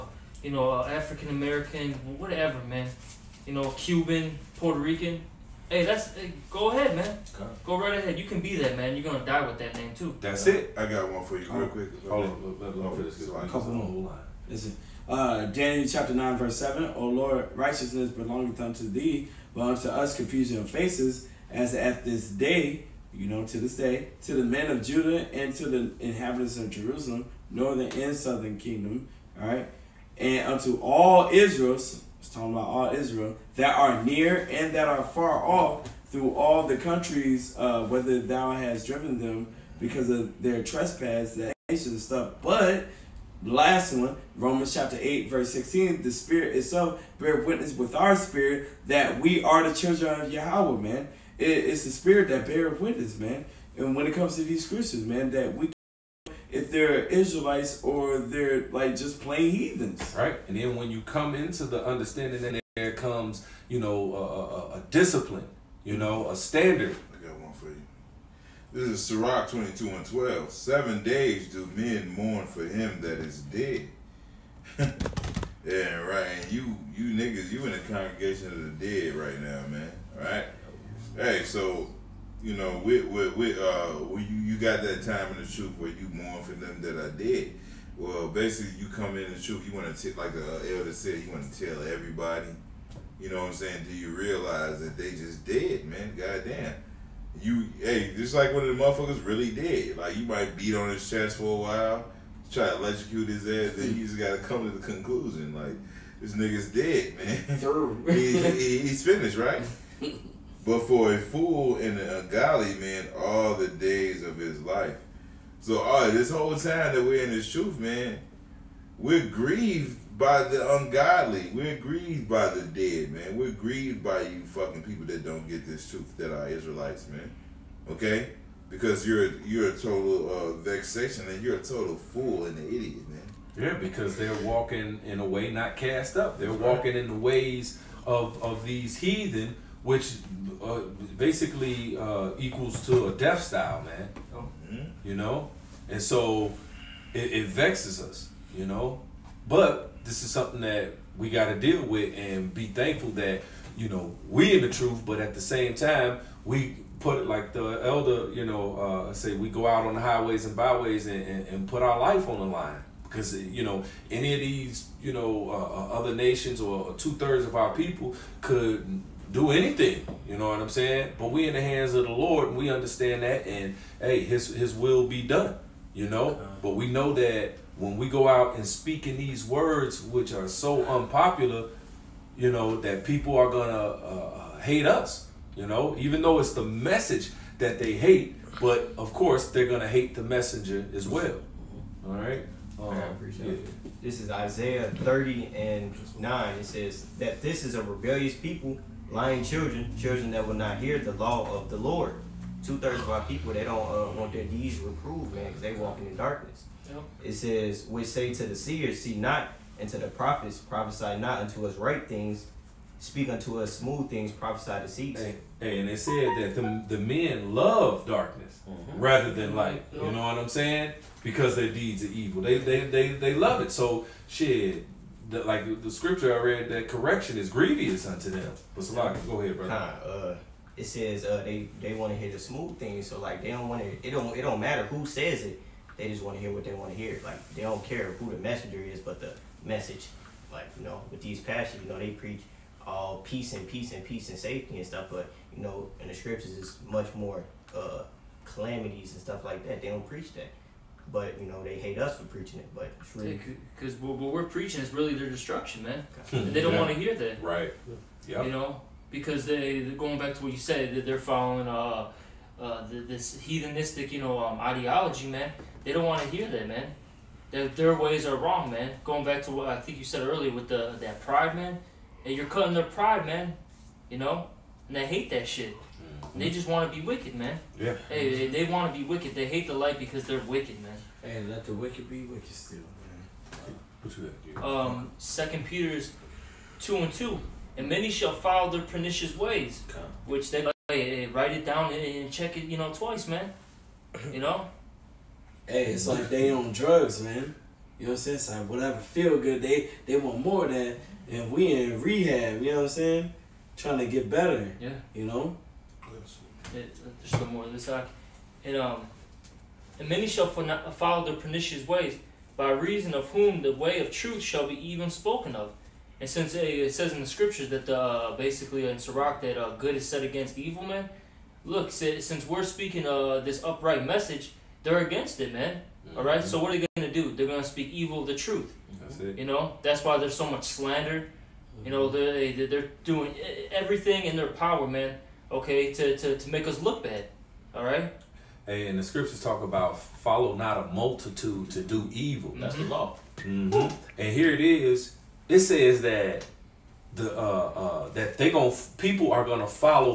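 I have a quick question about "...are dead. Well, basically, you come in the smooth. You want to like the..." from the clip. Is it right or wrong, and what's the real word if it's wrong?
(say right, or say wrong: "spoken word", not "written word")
wrong: "truth", not "smooth".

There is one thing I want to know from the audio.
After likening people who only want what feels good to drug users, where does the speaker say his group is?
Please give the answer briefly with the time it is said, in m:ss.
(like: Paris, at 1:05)
rehab, at 5:02.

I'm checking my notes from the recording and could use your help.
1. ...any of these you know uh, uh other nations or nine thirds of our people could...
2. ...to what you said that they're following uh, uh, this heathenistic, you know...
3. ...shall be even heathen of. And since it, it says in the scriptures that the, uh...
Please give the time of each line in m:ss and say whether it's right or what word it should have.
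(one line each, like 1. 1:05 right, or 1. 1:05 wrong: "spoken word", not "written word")
1. 2:44 wrong: "two", not "nine"
2. 4:20 right
3. 5:14 wrong: "spoken", not "heathen".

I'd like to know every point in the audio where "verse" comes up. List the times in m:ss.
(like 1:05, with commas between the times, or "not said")
0:16, 0:45.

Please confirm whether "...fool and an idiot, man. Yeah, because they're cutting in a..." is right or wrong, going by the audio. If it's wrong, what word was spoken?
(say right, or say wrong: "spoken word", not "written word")
wrong: "walking", not "cutting".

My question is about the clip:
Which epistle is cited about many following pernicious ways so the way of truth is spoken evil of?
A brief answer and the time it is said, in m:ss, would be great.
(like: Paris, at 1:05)
Second Peter, at 4:45.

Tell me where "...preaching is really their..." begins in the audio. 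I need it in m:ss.
4:14.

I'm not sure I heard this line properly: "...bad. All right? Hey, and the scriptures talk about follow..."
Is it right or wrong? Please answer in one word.
right.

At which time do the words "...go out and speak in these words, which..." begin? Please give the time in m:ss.
2:58.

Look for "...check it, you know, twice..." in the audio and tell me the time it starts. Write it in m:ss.
4:52.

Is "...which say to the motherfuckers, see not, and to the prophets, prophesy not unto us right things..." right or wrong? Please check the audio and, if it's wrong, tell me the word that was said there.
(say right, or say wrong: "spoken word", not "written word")
wrong: "seers", not "motherfuckers".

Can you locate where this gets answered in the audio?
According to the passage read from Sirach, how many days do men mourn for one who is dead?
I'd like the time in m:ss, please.
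1:10.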